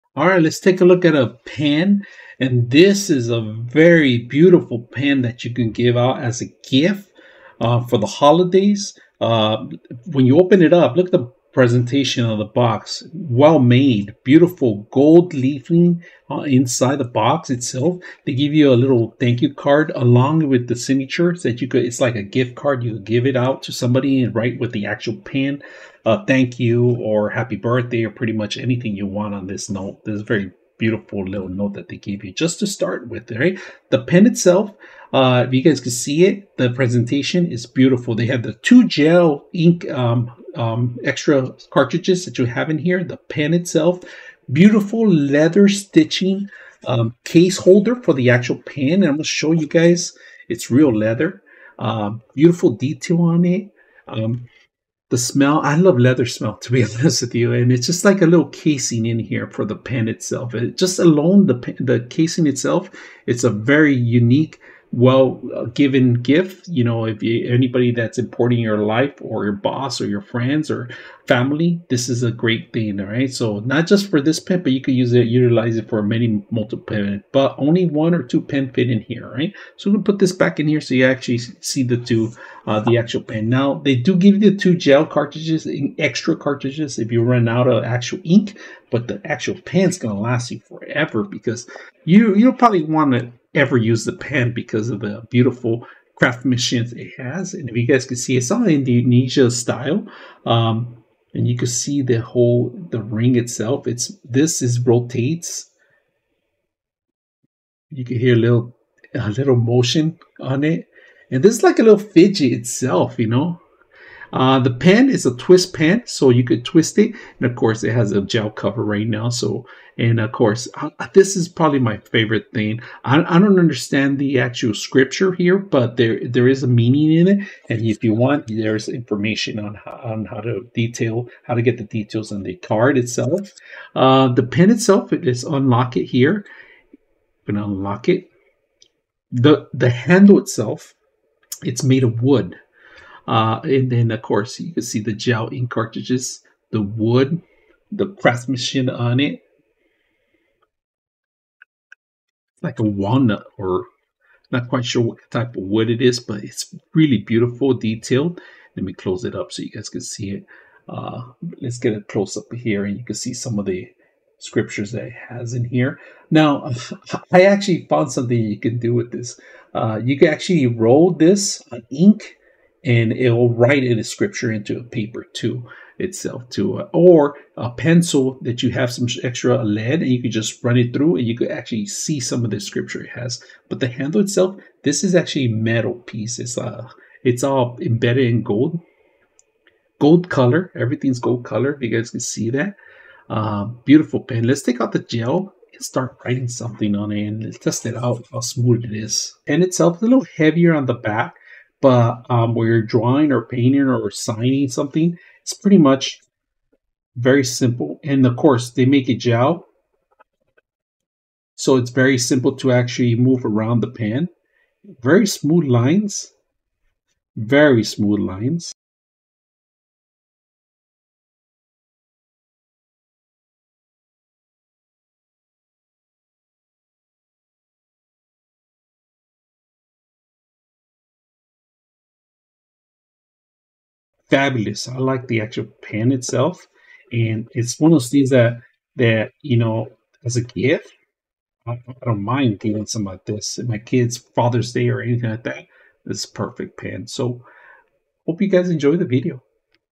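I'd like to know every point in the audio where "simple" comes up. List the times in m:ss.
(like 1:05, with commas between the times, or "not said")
3:27, 3:32.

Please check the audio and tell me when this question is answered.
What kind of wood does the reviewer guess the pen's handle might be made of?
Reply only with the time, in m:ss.
2:32.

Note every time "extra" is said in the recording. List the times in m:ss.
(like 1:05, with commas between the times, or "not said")
0:41, 1:25, 2:59.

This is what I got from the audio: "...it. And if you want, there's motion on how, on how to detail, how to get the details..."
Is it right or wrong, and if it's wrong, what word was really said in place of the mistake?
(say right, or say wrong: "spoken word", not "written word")
wrong: "information", not "motion".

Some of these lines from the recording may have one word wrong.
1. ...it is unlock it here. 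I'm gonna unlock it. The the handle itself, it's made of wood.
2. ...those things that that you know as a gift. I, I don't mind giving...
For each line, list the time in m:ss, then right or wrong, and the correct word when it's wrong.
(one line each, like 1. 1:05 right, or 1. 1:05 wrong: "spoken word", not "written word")
1. 2:15 right
2. 3:57 right.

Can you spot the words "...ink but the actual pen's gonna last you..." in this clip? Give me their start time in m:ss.
1:28.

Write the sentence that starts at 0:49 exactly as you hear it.
And I'm going to show you guys, it's real leather.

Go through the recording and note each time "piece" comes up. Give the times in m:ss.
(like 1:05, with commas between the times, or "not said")
3:05.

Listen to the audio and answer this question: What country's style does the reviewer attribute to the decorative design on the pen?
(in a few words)
Indonesia.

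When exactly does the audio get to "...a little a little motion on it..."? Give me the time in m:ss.
1:48.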